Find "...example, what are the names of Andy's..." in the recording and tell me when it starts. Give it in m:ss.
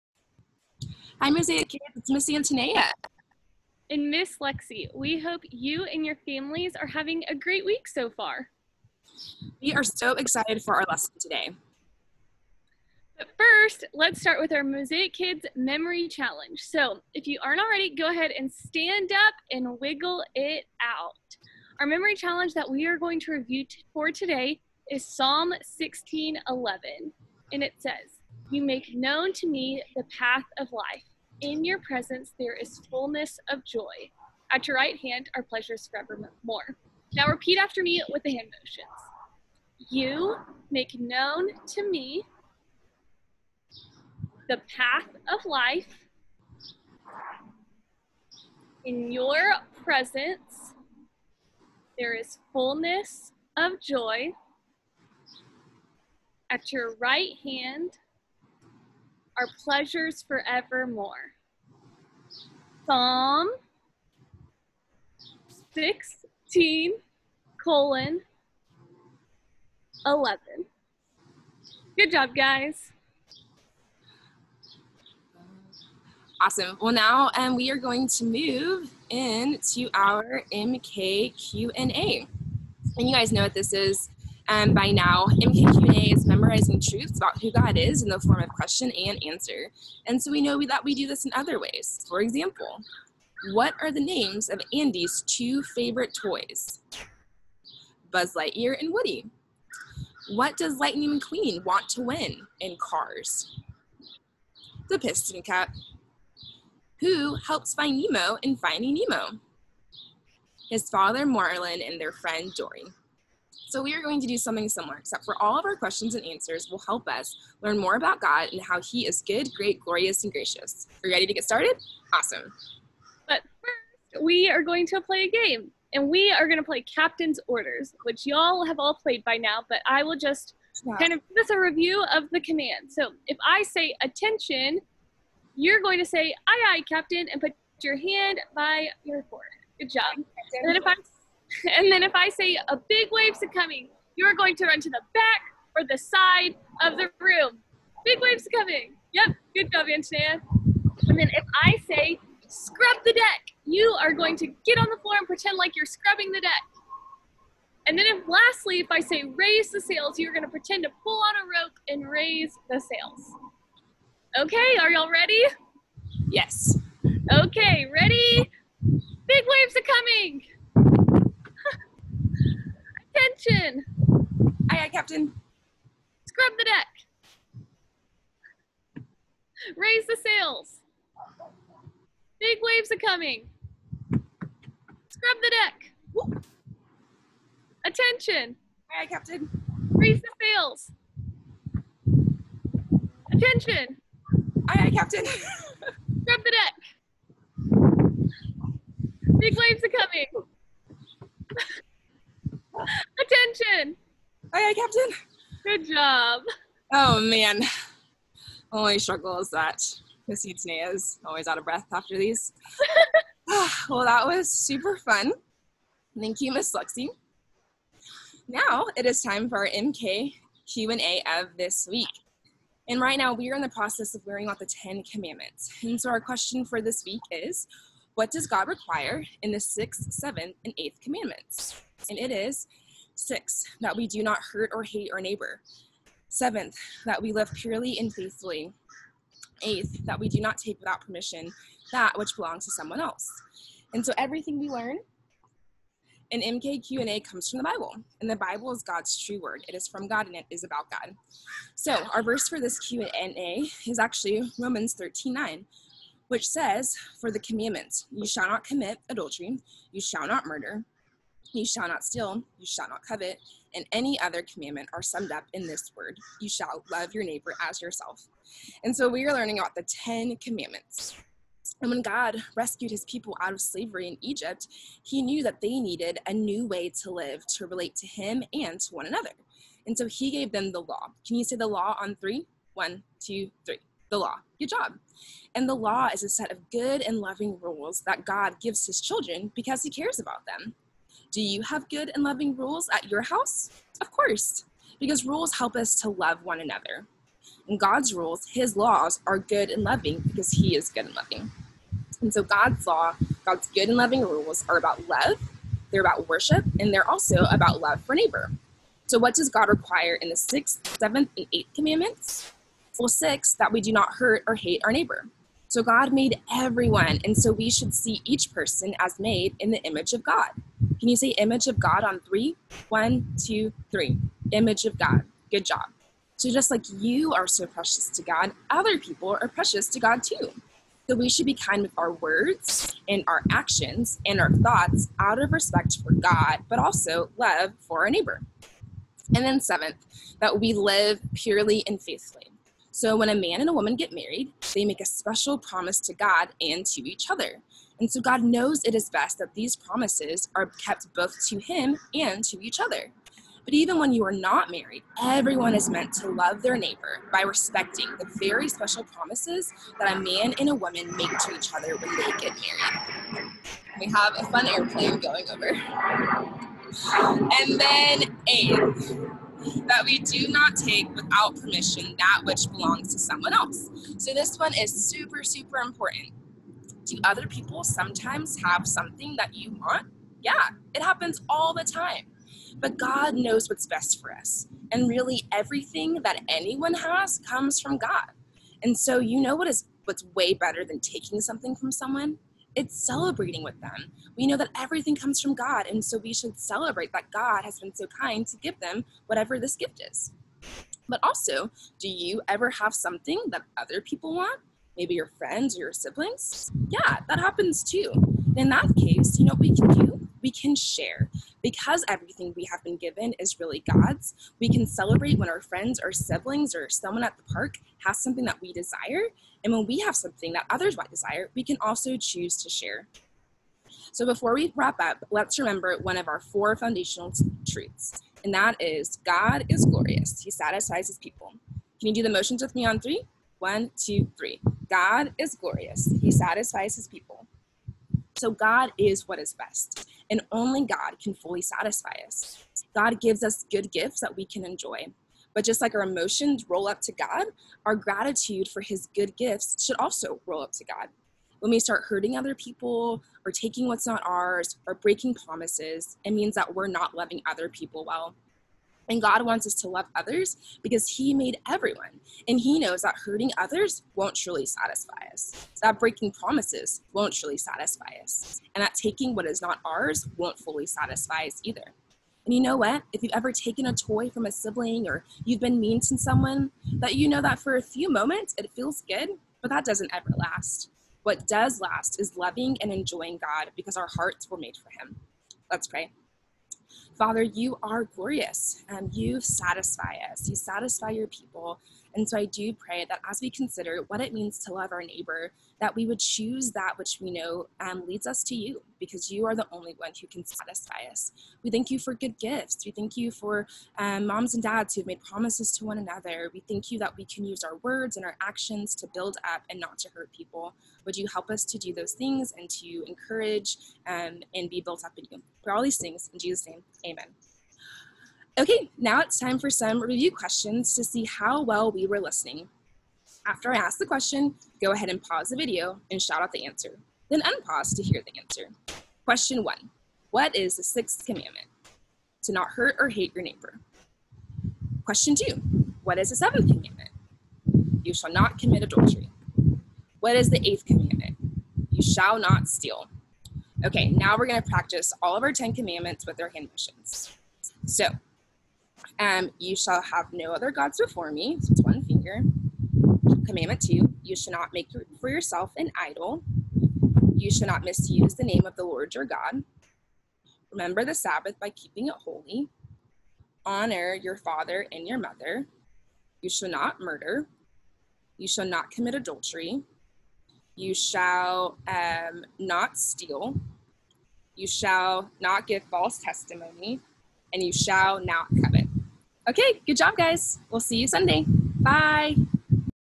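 1:32.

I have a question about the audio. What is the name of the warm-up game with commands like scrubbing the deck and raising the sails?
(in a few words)
Captain's Orders.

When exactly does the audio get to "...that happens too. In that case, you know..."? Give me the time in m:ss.
6:47.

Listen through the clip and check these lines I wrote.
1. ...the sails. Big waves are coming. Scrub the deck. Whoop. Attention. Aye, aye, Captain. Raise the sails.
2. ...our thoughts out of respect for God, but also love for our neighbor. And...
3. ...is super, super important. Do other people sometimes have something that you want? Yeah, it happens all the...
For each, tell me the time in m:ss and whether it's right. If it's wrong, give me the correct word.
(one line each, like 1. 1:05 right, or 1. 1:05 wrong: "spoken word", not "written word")
1. 3:00 right
2. 5:34 right
3. 6:14 right.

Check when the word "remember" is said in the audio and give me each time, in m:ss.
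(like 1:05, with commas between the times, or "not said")
7:05, 9:20.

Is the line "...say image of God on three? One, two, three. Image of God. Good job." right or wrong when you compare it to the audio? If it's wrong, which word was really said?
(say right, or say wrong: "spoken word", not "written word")
right.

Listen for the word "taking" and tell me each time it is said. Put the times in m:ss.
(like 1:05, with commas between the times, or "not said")
6:30, 7:33, 7:48.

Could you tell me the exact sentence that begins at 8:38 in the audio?
Okay, now it's time for some review questions to see how well we were listening.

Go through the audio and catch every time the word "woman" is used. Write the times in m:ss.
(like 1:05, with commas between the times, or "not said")
5:43, 6:00.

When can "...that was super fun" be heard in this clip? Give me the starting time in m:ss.
3:34.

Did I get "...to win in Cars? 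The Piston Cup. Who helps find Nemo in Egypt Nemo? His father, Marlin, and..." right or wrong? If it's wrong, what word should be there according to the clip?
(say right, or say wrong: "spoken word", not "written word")
wrong: "Finding", not "Egypt".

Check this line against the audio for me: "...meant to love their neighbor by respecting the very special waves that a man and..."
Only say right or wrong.
wrong.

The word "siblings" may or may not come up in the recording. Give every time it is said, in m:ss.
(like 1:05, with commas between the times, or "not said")
6:45, 6:56, 7:54.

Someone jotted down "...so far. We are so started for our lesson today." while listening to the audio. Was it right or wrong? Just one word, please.
wrong.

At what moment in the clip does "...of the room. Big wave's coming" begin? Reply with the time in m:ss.
2:26.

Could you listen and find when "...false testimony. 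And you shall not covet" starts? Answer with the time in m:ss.
9:35.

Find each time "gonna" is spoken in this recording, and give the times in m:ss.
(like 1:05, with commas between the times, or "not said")
2:40, 9:04.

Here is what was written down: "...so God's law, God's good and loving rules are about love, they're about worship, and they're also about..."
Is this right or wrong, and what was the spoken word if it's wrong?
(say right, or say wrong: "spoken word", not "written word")
right.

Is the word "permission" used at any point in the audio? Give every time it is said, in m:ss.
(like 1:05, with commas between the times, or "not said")
4:01, 6:11.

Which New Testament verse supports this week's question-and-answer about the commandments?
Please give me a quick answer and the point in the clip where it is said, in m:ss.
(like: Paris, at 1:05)
Romans 13:9, at 4:14.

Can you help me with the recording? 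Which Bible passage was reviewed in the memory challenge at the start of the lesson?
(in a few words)
Psalm 16:11.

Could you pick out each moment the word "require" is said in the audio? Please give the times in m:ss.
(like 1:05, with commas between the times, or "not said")
3:48, 5:09.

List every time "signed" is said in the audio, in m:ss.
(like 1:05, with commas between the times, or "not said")
not said.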